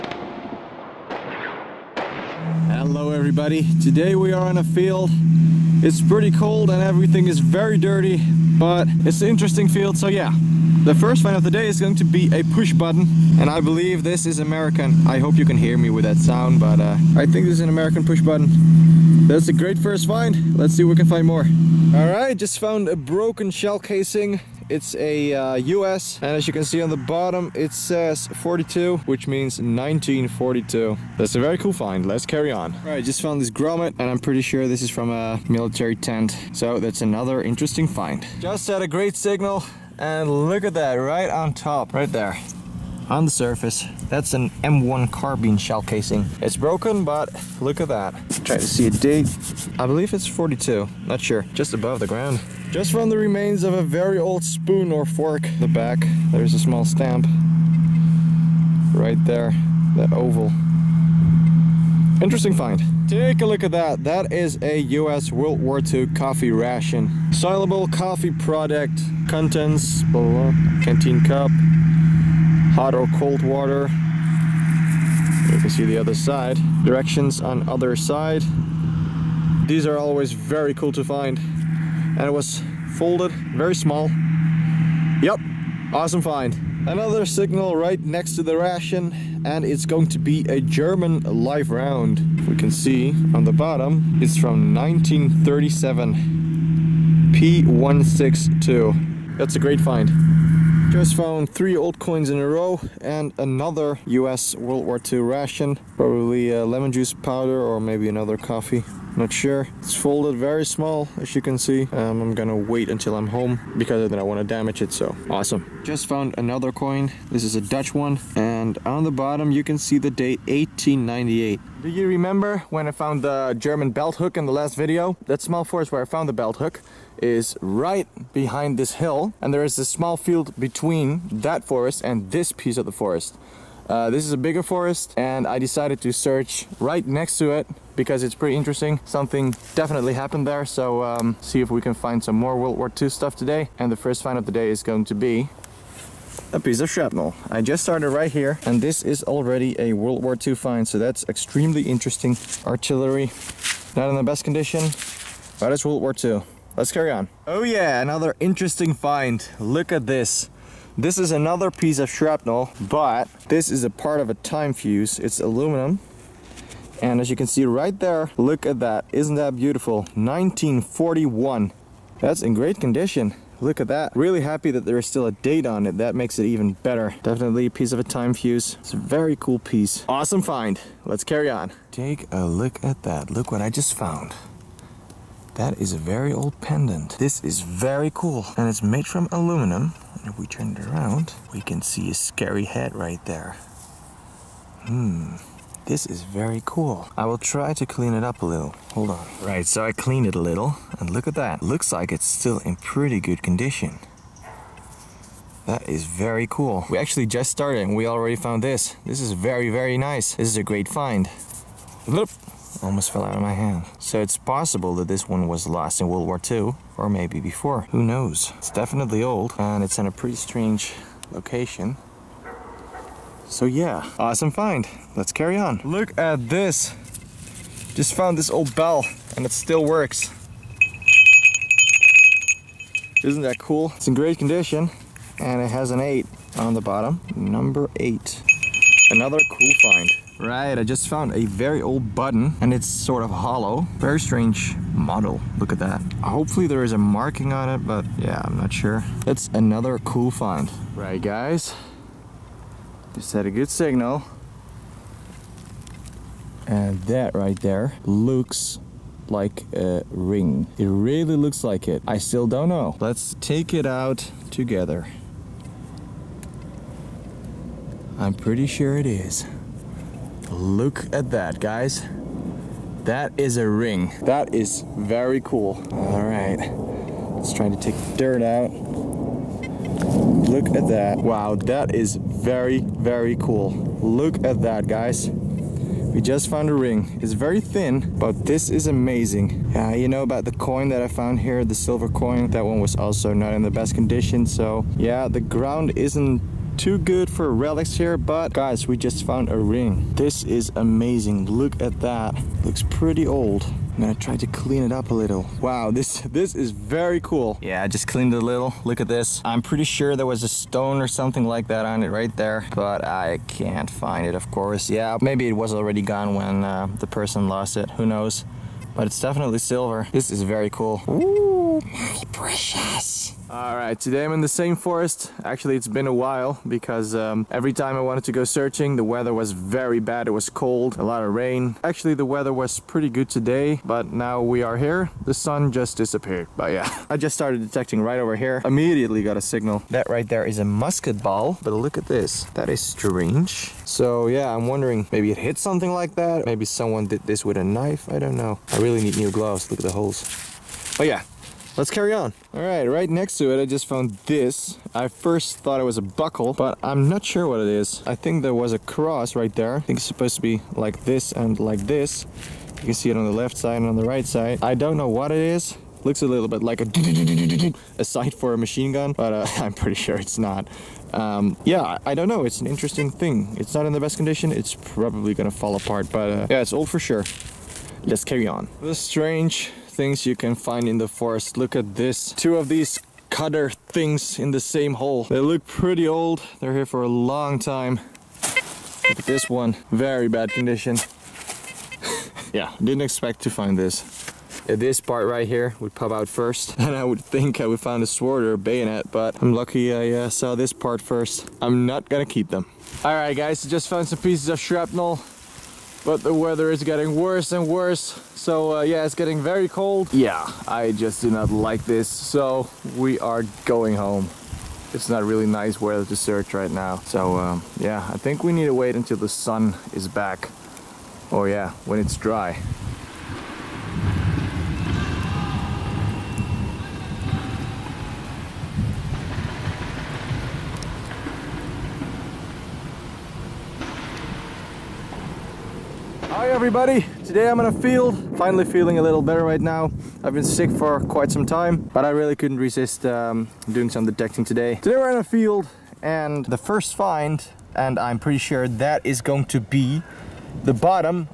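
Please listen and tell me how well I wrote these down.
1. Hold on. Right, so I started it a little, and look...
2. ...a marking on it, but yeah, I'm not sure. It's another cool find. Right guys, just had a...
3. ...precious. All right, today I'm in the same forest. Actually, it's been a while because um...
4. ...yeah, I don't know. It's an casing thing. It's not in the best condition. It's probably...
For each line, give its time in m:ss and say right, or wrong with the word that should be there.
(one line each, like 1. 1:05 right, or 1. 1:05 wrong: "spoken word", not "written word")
1. 3:18 wrong: "cleaned", not "started"
2. 4:06 right
3. 5:22 right
4. 6:11 wrong: "interesting", not "casing".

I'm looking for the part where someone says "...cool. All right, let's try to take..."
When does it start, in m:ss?
4:35.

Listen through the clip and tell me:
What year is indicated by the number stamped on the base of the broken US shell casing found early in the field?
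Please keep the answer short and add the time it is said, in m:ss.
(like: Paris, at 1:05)
1942, at 0:29.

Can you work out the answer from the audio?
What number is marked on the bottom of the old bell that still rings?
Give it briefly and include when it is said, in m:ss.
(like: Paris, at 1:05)
8, at 3:57.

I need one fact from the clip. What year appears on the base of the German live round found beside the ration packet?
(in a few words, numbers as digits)
1937.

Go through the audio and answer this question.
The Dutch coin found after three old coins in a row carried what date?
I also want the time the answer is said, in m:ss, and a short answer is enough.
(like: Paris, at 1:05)
1898, at 2:00.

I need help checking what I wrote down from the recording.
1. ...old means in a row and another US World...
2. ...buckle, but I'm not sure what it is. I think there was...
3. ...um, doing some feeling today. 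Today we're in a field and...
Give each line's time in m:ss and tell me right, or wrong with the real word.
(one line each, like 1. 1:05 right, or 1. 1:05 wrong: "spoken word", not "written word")
1. 1:41 wrong: "coins", not "means"
2. 5:56 right
3. 7:23 wrong: "detecting", not "feeling".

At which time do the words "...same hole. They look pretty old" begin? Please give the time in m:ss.
6:24.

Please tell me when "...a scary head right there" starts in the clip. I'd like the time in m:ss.
3:12.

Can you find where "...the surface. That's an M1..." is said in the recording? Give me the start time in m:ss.
0:43.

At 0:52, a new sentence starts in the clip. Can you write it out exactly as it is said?
Just from the remains of a very old spoon or fork.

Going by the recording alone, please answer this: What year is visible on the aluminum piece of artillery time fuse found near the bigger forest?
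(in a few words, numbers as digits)
1941.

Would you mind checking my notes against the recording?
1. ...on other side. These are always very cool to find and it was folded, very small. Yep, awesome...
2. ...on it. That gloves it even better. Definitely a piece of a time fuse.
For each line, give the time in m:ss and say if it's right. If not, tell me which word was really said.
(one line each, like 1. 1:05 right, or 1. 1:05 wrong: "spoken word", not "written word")
1. 1:17 right
2. 2:55 wrong: "makes", not "gloves".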